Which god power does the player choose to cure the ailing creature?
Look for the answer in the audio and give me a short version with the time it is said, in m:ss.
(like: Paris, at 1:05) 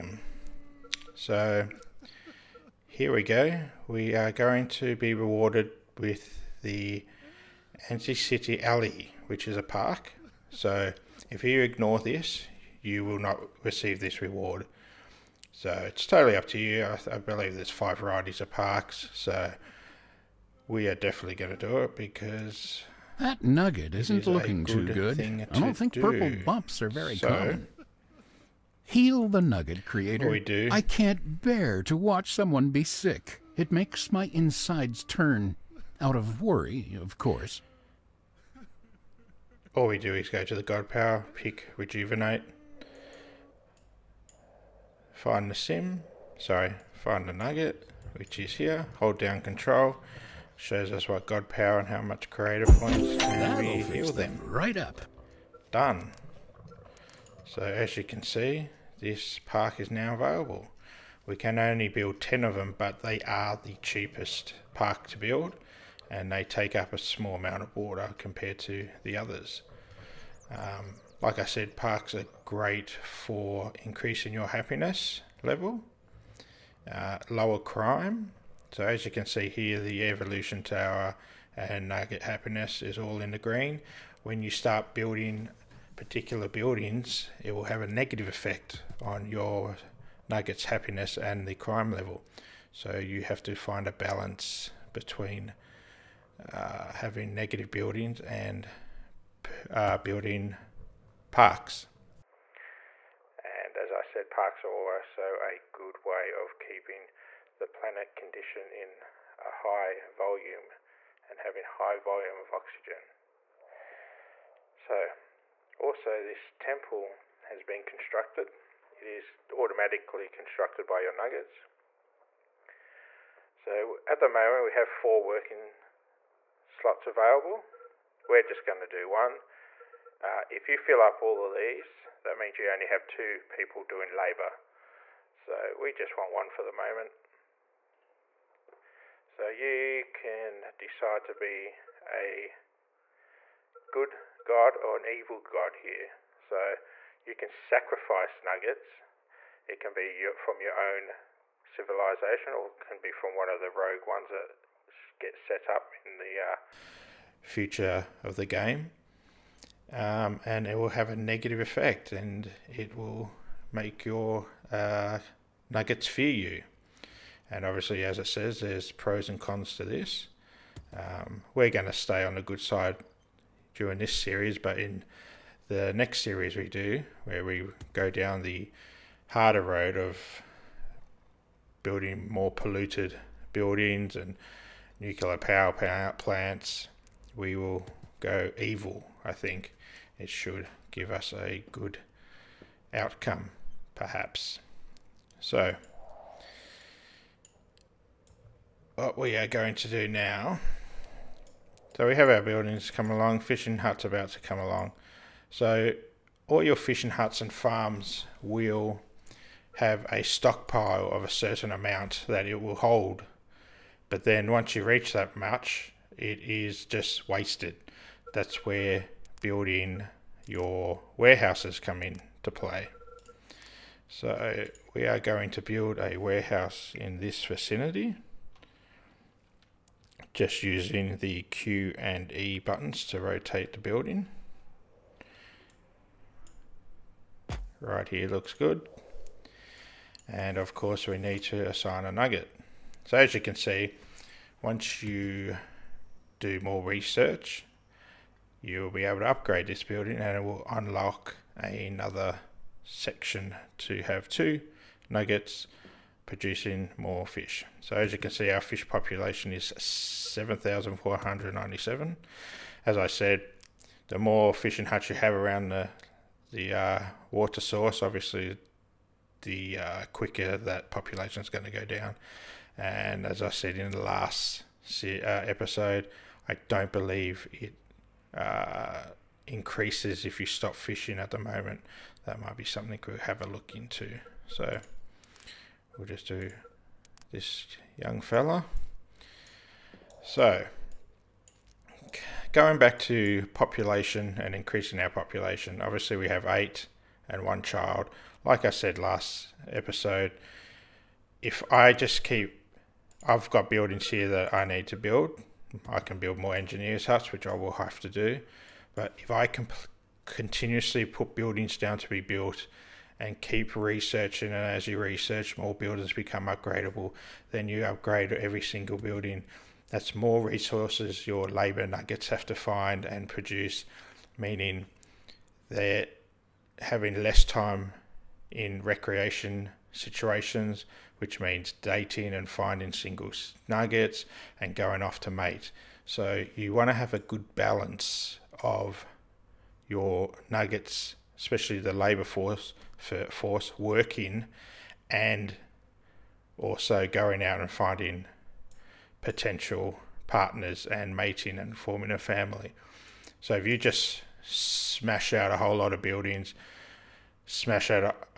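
Rejuvenate, at 0:41.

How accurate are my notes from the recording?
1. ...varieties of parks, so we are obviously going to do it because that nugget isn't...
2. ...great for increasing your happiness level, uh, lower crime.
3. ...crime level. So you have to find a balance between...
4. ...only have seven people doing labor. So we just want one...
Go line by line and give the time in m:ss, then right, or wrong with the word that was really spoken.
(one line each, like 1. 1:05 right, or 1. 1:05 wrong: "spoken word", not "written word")
1. 0:17 wrong: "definitely", not "obviously"
2. 1:12 right
3. 1:31 right
4. 2:12 wrong: "two", not "seven".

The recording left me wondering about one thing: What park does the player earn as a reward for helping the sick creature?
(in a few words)
Anti-City Alley.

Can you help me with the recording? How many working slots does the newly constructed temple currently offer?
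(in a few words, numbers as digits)
4.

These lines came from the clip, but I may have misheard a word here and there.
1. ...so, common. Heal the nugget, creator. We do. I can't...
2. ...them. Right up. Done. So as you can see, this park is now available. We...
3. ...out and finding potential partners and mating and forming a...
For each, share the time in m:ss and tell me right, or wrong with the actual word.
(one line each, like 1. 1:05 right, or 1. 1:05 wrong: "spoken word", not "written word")
1. 0:27 right
2. 0:54 right
3. 5:47 right.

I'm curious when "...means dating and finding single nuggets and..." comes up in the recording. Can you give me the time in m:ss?
5:31.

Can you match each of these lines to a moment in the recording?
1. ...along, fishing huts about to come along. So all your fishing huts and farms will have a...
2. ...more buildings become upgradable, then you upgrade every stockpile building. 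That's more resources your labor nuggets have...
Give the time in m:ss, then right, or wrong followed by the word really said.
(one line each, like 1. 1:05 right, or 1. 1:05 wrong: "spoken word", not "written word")
1. 3:23 right
2. 5:15 wrong: "single", not "stockpile".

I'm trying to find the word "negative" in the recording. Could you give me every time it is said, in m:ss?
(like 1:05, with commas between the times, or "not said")
1:27, 1:37, 2:41.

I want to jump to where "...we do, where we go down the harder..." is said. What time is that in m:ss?
2:56.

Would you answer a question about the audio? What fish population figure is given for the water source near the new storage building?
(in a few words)
7,497.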